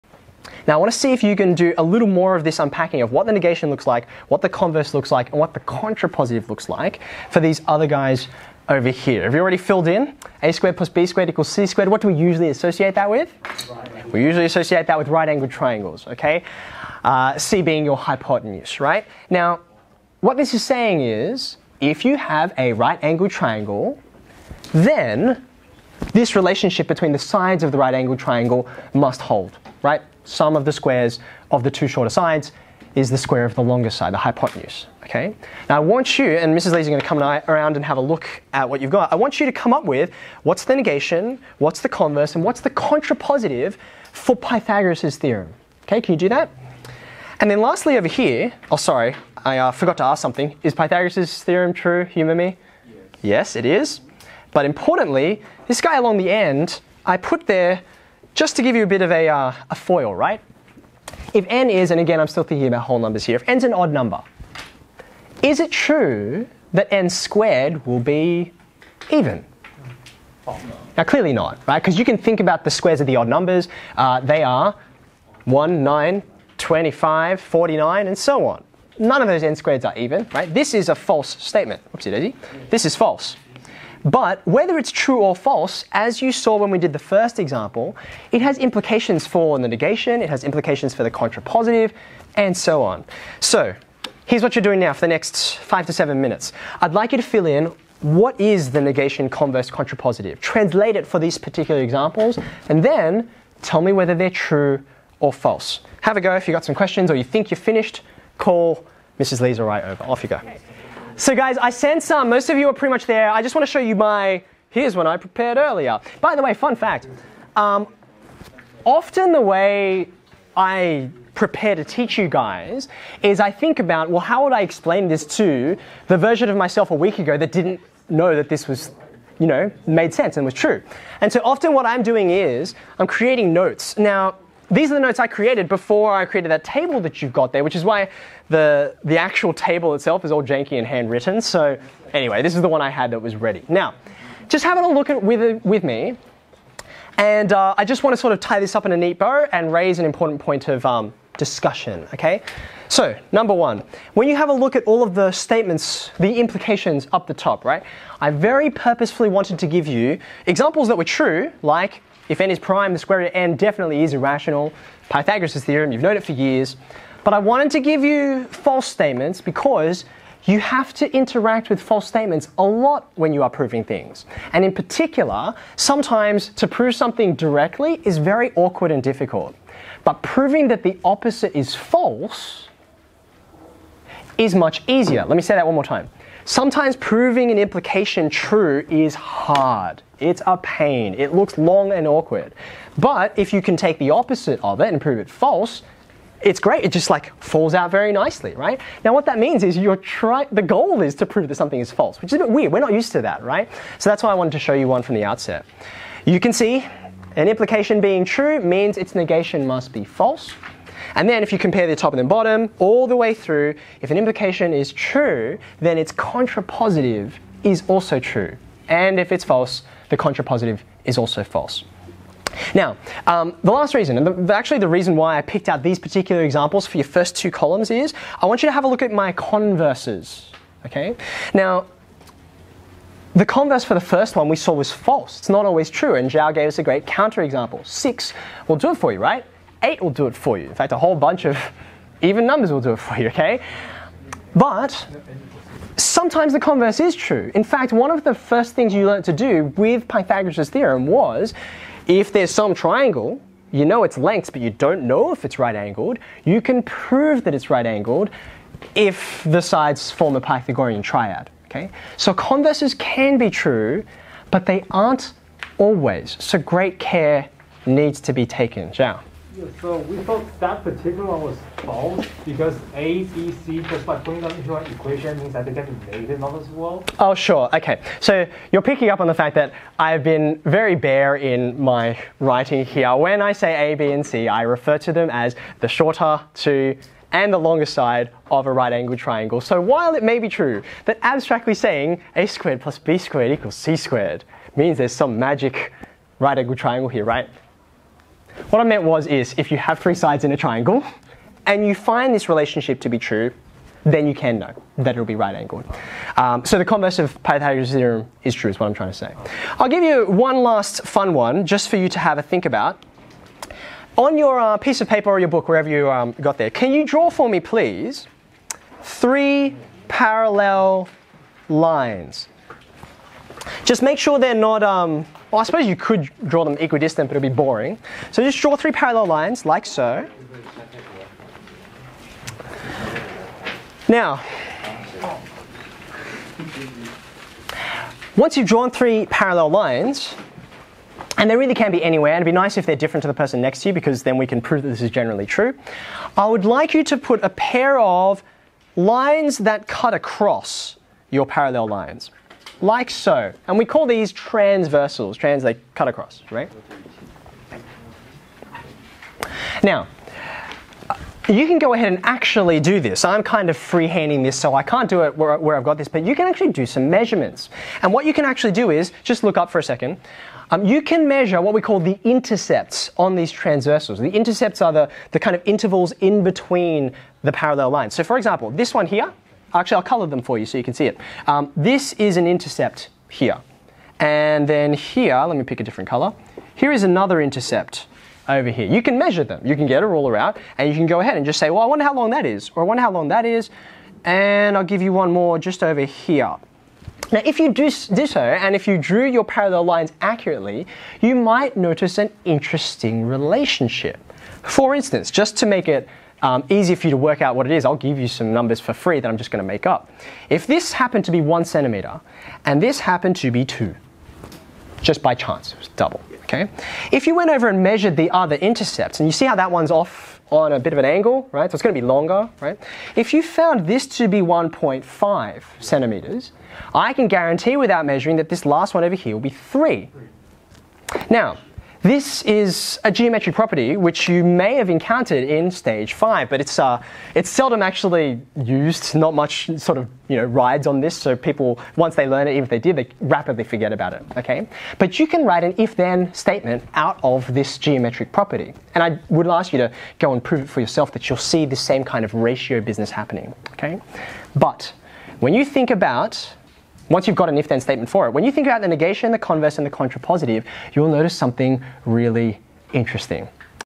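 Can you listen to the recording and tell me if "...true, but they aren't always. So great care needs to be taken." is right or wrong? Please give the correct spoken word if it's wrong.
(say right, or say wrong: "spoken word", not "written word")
right.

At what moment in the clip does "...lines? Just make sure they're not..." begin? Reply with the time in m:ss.
5:21.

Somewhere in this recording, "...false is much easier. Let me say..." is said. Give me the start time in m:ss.
3:01.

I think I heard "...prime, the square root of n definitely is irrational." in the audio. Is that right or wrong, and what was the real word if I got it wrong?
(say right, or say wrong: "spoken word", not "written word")
right.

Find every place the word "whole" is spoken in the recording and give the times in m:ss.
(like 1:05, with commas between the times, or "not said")
1:02, 4:00.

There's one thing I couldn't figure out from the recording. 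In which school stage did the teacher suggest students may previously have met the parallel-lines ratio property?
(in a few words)
stage 5.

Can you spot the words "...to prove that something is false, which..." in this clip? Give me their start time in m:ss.
3:21.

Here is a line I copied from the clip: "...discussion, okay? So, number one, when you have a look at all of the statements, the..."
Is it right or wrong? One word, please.
right.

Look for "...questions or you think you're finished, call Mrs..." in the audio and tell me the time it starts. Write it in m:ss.
1:46.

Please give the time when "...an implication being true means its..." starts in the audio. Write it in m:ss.
3:27.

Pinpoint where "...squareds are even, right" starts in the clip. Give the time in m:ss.
1:19.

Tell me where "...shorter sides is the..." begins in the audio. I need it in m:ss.
0:31.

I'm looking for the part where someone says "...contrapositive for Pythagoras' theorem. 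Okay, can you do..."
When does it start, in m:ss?
0:42.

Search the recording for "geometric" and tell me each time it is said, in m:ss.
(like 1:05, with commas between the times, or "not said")
7:13, 7:27.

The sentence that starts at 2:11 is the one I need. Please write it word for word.
And so often what I'm doing is I'm creating notes.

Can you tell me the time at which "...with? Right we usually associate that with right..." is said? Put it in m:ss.
0:13.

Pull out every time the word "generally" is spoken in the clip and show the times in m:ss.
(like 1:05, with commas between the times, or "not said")
5:45.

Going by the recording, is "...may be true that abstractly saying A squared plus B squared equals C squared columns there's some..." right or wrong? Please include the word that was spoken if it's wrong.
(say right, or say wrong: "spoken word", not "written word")
wrong: "means", not "columns".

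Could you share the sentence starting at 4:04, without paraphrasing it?
But sometimes the converse is true.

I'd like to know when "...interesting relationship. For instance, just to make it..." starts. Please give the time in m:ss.
6:42.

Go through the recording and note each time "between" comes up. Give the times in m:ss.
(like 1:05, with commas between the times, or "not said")
0:26, 6:16.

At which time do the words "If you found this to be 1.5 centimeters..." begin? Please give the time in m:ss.
7:03.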